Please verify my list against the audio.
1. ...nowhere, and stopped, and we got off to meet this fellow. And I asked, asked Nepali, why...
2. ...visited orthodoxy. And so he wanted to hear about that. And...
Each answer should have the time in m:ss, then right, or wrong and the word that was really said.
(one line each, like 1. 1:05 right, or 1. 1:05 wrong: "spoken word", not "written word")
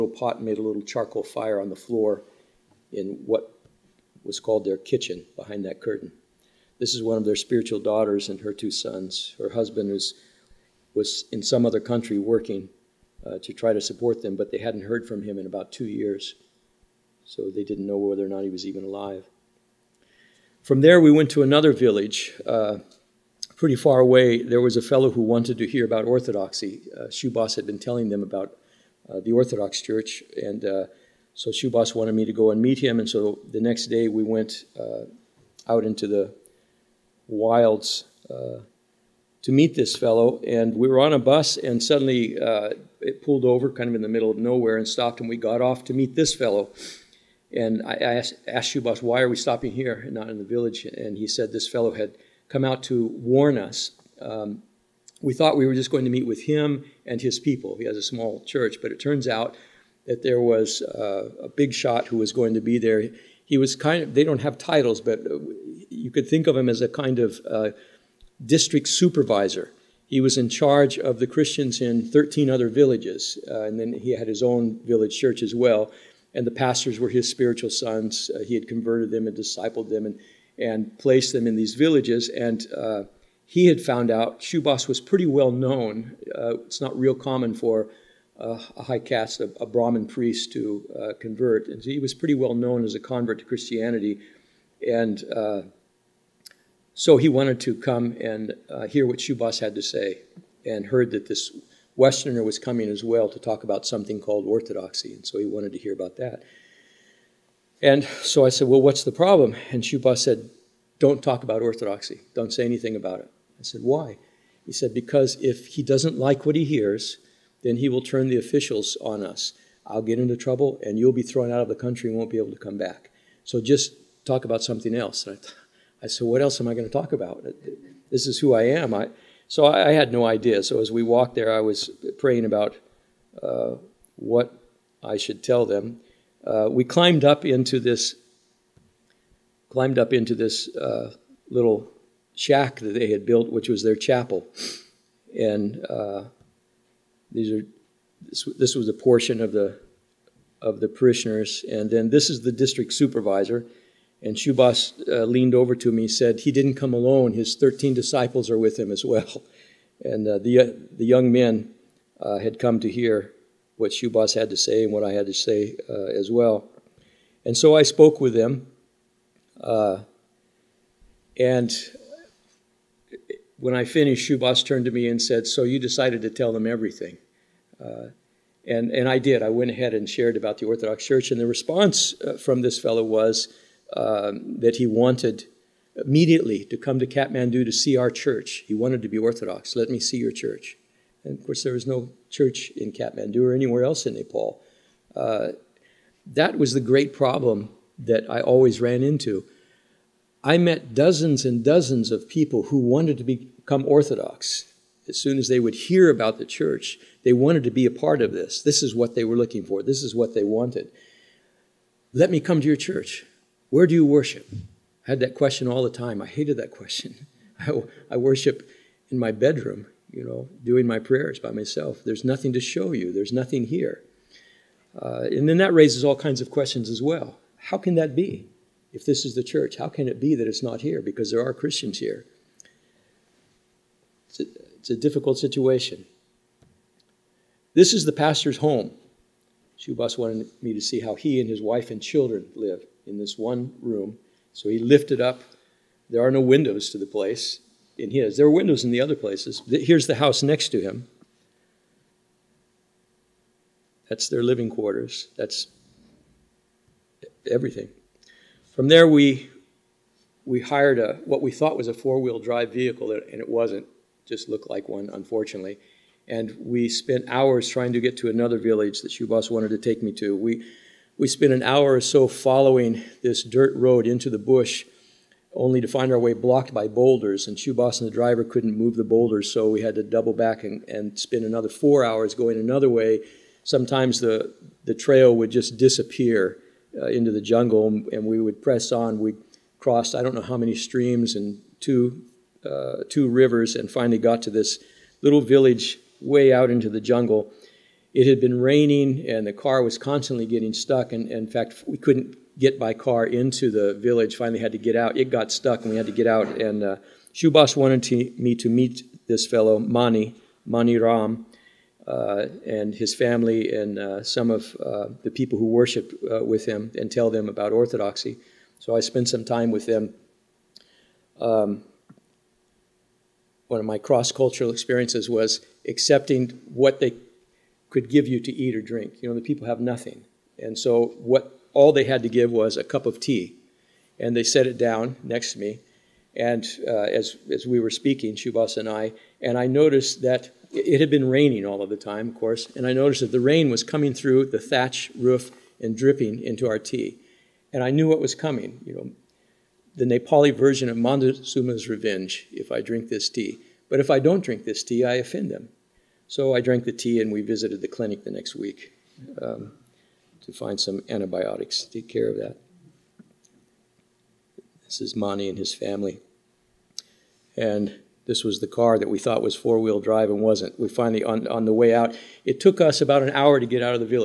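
1. 0:44 wrong: "Shubas", not "Nepali"
2. 1:44 wrong: "called", not "visited".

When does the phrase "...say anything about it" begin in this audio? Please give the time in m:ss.
1:52.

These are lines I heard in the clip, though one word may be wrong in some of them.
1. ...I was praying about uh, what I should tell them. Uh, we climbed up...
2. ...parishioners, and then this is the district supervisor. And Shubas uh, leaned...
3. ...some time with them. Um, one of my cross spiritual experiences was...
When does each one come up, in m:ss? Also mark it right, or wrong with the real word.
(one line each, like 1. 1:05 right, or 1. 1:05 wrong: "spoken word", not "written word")
1. 2:11 right
2. 2:30 right
3. 5:19 wrong: "cultural", not "spiritual".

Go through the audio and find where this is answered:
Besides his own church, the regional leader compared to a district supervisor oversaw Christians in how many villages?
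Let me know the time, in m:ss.
1:12.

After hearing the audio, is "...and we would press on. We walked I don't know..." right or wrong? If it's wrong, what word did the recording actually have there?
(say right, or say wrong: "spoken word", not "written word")
wrong: "crossed", not "walked".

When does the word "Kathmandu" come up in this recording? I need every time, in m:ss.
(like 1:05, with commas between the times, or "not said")
3:07, 3:12.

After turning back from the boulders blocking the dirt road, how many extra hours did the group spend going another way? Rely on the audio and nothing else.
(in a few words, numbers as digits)
4 hours.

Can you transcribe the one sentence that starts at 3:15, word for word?
Uh, that was the great problem that I always ran into.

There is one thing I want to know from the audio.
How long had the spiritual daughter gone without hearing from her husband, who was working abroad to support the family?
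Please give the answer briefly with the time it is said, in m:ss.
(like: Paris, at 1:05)
2 years, at 0:15.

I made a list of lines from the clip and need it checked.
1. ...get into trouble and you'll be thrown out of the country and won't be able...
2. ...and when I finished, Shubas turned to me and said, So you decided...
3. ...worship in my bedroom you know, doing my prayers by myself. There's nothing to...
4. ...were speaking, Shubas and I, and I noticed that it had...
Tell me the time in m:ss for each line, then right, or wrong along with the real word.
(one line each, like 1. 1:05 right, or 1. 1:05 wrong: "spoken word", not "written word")
1. 2:00 right
2. 2:51 right
3. 3:38 right
4. 5:37 right.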